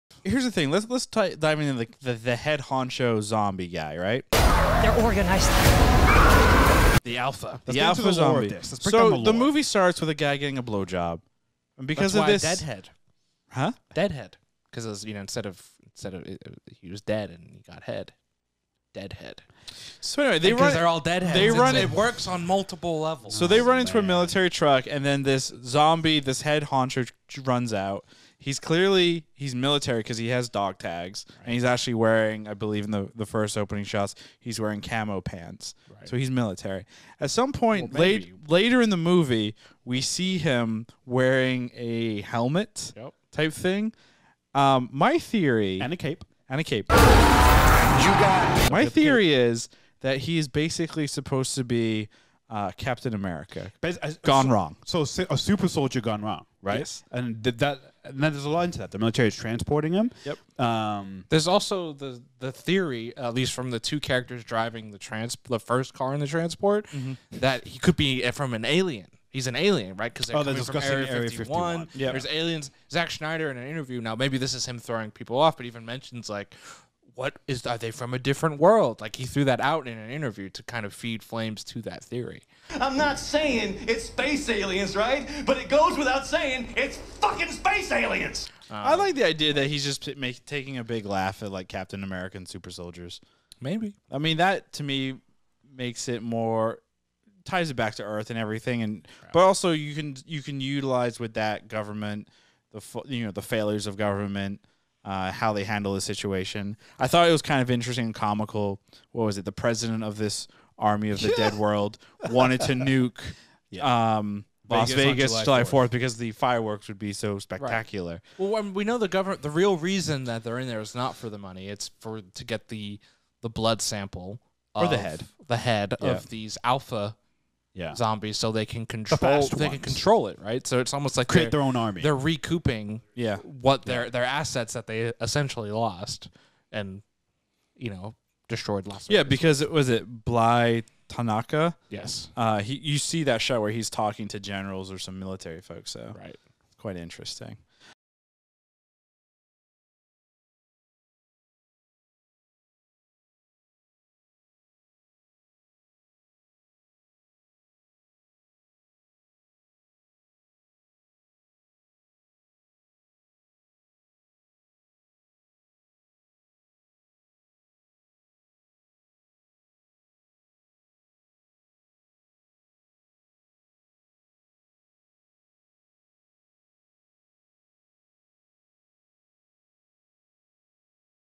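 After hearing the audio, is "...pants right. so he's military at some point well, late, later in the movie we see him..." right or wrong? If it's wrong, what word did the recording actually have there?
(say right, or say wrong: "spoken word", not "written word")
right.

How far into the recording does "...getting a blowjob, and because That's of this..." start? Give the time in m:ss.
0:10.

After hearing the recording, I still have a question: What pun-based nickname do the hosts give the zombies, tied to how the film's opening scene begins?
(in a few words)
Deadheads.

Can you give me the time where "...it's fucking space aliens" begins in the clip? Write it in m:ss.
1:26.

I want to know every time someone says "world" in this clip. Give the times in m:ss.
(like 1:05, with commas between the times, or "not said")
1:18, 1:51.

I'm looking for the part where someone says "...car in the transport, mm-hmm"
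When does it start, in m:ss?
1:05.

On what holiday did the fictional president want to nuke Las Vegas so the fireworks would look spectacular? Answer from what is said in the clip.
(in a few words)
July Fourth.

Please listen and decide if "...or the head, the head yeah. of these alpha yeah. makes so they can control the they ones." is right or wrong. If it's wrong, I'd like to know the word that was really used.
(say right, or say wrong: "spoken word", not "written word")
wrong: "zombies", not "makes".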